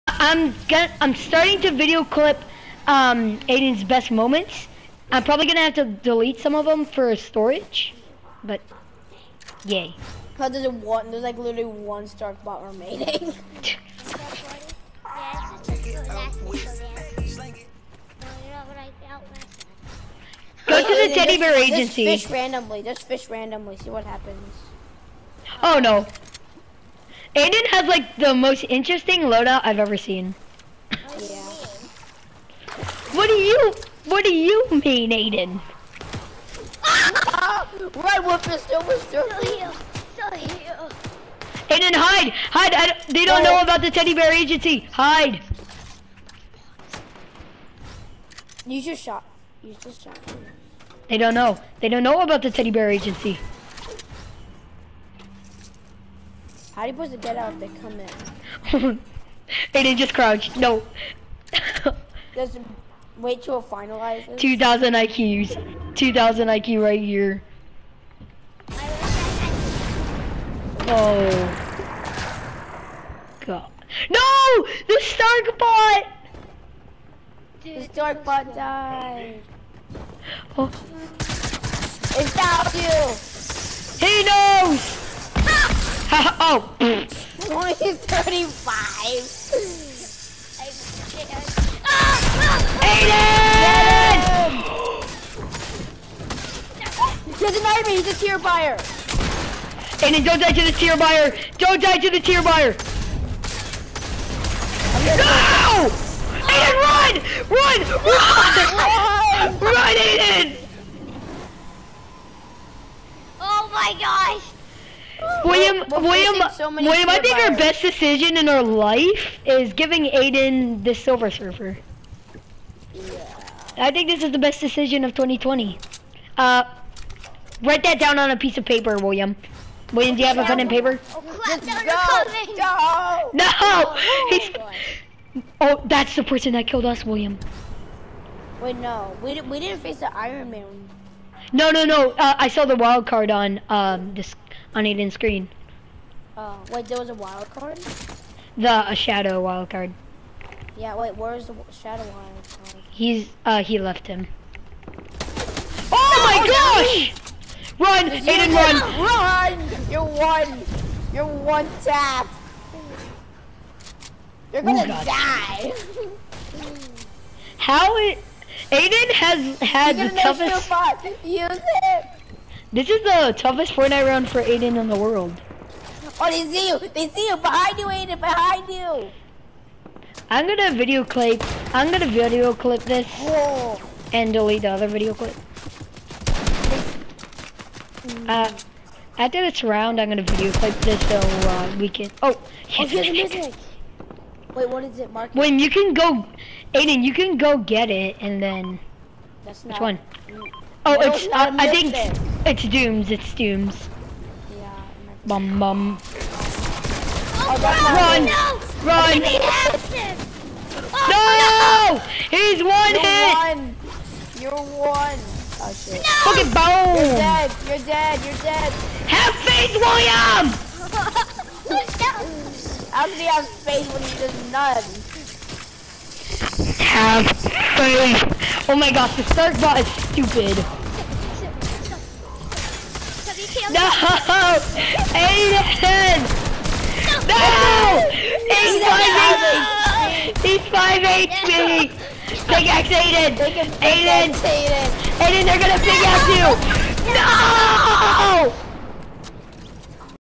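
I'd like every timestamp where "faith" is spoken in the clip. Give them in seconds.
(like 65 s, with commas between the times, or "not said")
219 s, 223 s, 227 s.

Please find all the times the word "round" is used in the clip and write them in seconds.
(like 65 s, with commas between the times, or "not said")
174 s, 189 s.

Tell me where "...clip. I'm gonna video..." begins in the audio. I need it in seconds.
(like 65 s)
181 s.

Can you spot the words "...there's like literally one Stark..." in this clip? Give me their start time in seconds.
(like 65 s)
11 s.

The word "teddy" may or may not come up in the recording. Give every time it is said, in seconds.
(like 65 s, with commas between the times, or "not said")
21 s, 43 s, 52 s.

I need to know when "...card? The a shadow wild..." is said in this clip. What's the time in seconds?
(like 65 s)
147 s.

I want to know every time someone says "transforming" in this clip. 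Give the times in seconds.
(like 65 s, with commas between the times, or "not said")
not said.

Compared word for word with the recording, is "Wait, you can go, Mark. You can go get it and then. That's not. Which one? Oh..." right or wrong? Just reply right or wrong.
wrong.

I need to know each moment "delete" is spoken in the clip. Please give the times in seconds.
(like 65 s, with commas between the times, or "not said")
5 s, 184 s.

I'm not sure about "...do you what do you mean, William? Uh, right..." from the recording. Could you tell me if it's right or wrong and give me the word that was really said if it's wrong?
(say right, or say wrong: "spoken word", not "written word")
wrong: "Aiden", not "William".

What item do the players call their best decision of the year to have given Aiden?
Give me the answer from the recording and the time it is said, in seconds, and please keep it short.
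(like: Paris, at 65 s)
Silver Surfer, at 120 s.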